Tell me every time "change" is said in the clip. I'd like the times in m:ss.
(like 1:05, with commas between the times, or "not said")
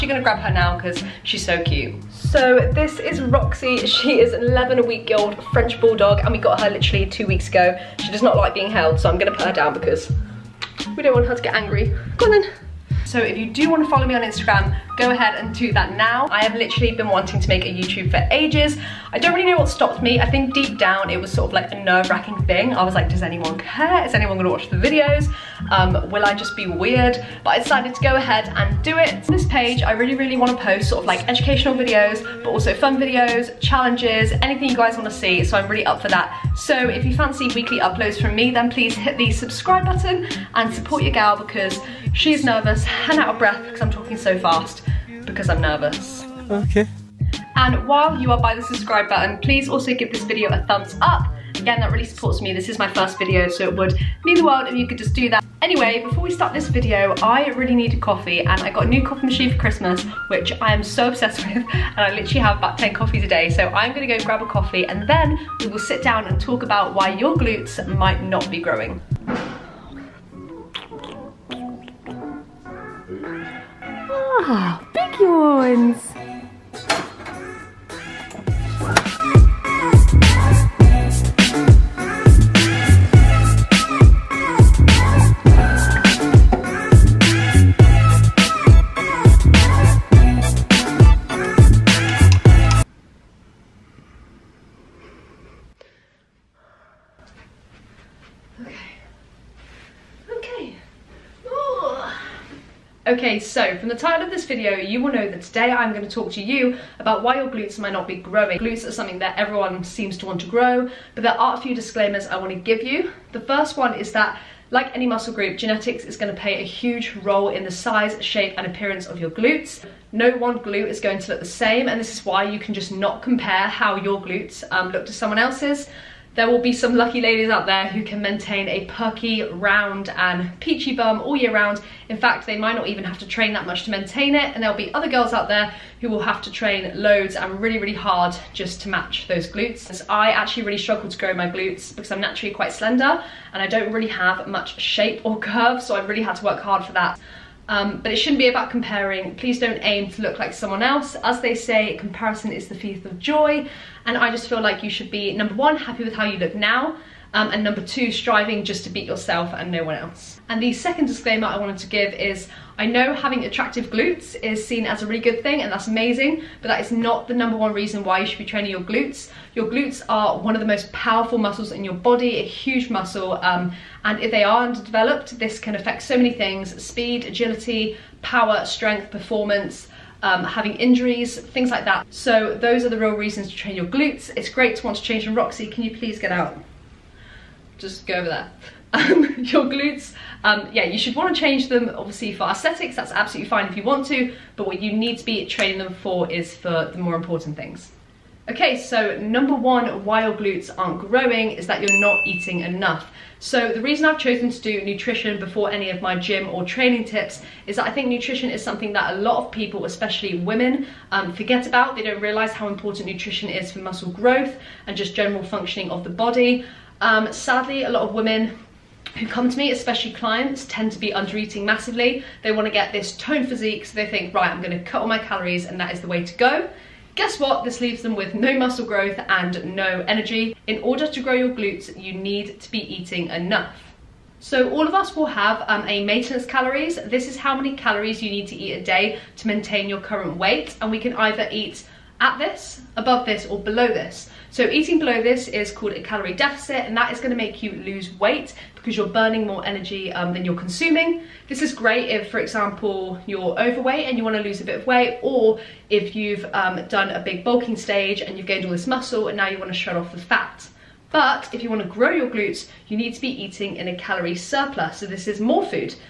3:05, 3:11.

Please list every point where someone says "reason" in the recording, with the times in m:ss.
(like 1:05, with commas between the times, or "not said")
2:47, 3:03, 3:23.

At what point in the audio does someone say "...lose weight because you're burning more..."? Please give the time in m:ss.
4:07.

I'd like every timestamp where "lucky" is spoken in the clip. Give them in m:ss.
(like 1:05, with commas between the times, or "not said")
2:06.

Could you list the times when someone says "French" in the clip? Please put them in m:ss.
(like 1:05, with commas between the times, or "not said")
0:05.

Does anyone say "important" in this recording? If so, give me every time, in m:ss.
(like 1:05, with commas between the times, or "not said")
3:17, 3:32.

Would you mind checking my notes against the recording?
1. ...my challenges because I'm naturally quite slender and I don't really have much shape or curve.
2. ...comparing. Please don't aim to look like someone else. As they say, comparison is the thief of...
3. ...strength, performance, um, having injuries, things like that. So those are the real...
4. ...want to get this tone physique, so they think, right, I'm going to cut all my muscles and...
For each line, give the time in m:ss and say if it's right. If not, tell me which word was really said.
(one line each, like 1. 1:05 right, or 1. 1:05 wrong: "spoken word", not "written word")
1. 2:21 wrong: "glutes", not "challenges"
2. 2:28 right
3. 2:58 right
4. 3:42 wrong: "calories", not "muscles".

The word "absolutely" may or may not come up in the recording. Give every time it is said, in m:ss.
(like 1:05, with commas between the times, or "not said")
3:13.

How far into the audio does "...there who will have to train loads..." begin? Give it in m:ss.
2:15.